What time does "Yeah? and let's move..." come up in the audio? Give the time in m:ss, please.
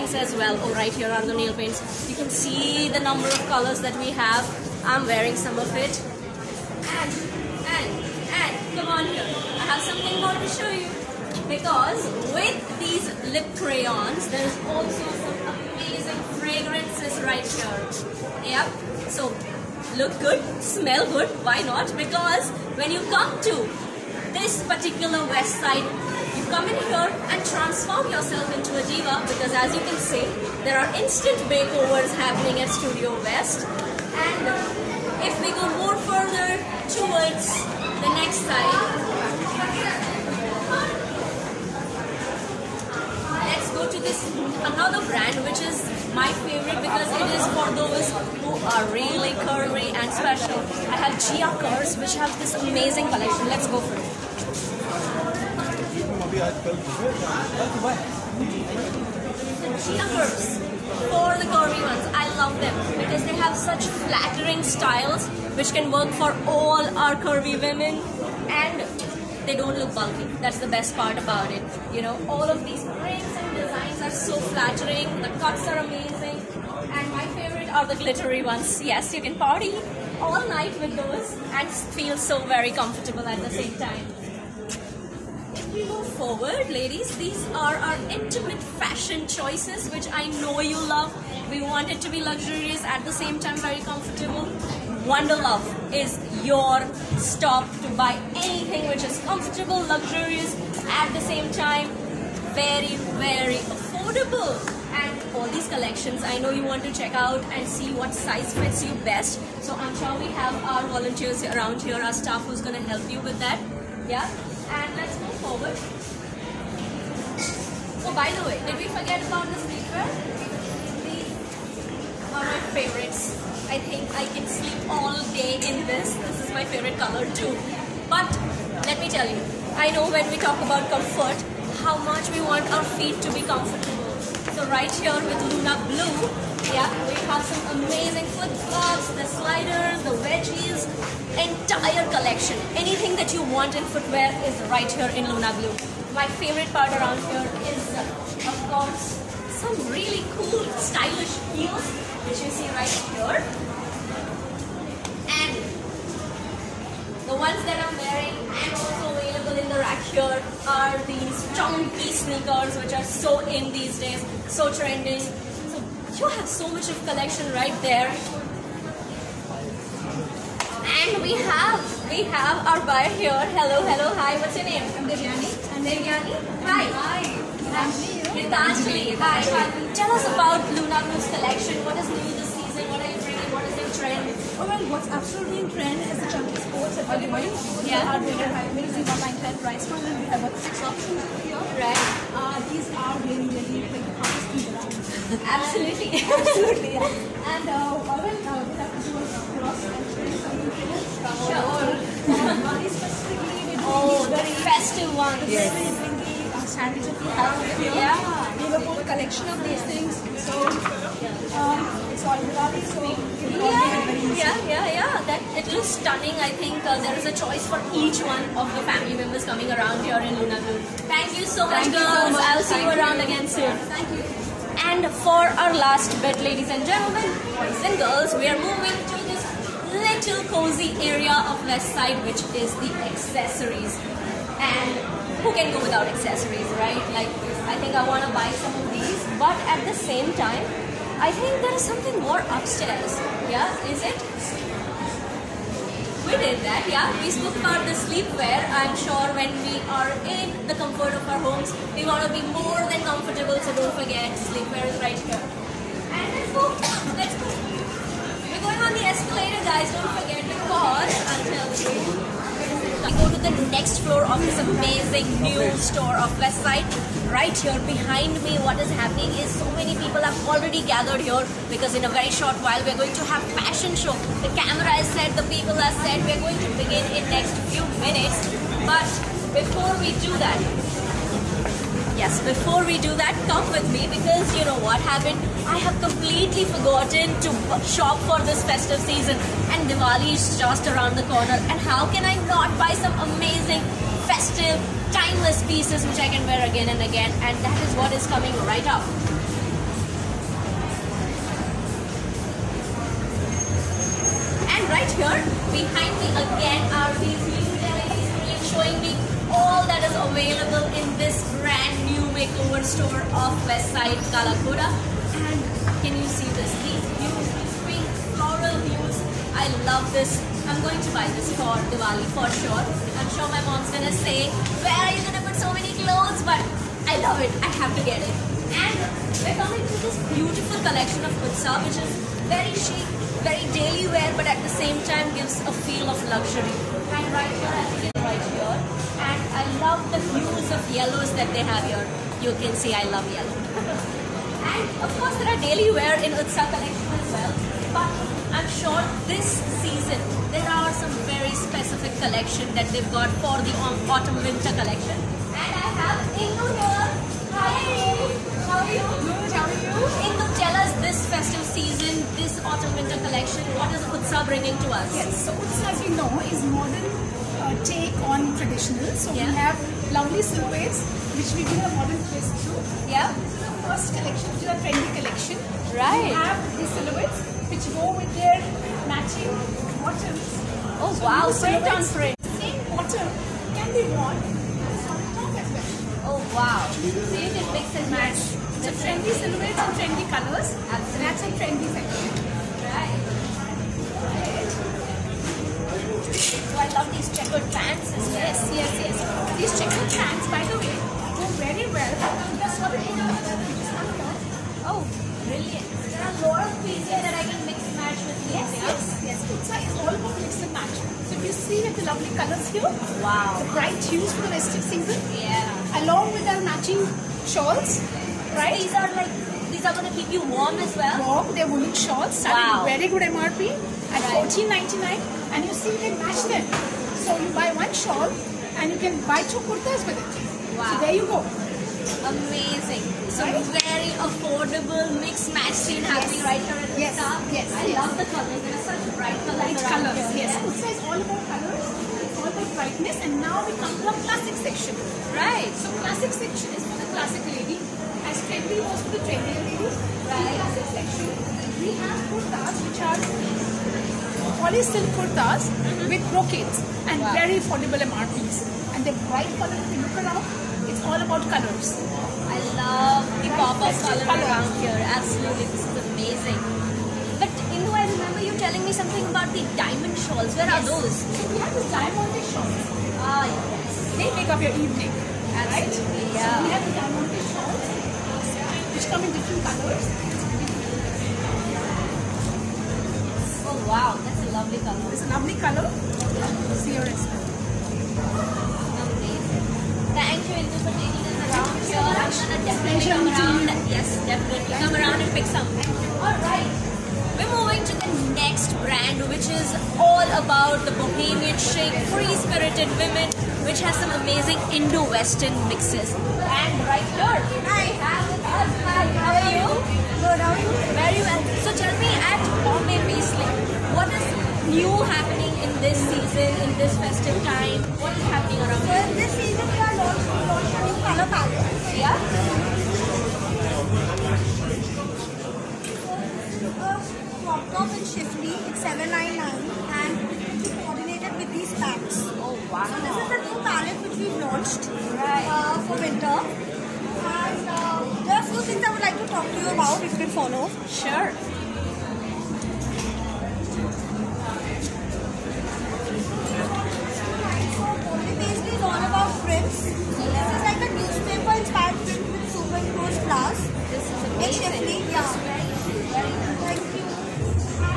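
1:54.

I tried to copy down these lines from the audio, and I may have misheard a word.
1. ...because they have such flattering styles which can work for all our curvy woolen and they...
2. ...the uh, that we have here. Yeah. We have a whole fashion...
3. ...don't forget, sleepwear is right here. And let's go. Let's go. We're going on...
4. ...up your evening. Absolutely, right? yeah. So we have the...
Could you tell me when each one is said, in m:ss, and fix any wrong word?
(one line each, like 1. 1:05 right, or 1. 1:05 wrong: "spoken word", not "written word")
1. 1:02 wrong: "women", not "woolen"
2. 3:26 wrong: "collection", not "fashion"
3. 4:13 right
4. 7:54 right.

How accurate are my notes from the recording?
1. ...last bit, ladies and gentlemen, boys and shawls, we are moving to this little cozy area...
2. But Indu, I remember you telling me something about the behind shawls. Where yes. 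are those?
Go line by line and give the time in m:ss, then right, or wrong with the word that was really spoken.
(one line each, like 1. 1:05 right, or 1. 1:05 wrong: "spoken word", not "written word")
1. 3:45 wrong: "girls", not "shawls"
2. 7:47 wrong: "diamond", not "behind".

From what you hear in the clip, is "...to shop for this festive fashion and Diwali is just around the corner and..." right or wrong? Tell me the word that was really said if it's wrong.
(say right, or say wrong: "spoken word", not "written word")
wrong: "season", not "fashion".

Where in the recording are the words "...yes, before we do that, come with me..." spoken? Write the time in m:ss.
4:42.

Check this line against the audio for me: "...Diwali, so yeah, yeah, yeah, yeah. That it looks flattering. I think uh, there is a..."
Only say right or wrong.
wrong.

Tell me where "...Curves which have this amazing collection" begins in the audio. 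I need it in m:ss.
0:51.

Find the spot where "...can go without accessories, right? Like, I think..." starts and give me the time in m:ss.
3:55.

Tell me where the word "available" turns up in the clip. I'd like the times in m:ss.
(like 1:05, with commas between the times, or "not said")
2:39, 5:10.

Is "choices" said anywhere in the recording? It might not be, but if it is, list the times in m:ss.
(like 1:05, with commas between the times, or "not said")
1:29, 3:37.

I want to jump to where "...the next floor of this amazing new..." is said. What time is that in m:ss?
4:23.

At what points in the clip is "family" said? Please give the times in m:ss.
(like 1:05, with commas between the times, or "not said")
3:38.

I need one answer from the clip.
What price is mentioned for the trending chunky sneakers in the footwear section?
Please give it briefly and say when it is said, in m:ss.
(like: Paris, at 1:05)
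1910, at 3:09.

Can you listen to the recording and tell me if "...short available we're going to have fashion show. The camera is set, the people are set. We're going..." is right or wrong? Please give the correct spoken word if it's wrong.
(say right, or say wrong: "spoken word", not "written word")
wrong: "while", not "available".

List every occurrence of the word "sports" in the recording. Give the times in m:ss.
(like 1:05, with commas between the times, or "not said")
3:06.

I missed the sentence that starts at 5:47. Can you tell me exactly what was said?
But I'm sure this season there are some very specific collection that they've got for the autumn winter collection.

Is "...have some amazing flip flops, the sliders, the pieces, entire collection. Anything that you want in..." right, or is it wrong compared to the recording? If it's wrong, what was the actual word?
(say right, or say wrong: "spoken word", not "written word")
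wrong: "wedgies", not "pieces".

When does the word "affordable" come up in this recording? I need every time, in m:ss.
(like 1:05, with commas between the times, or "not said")
1:43, 7:14, 7:37.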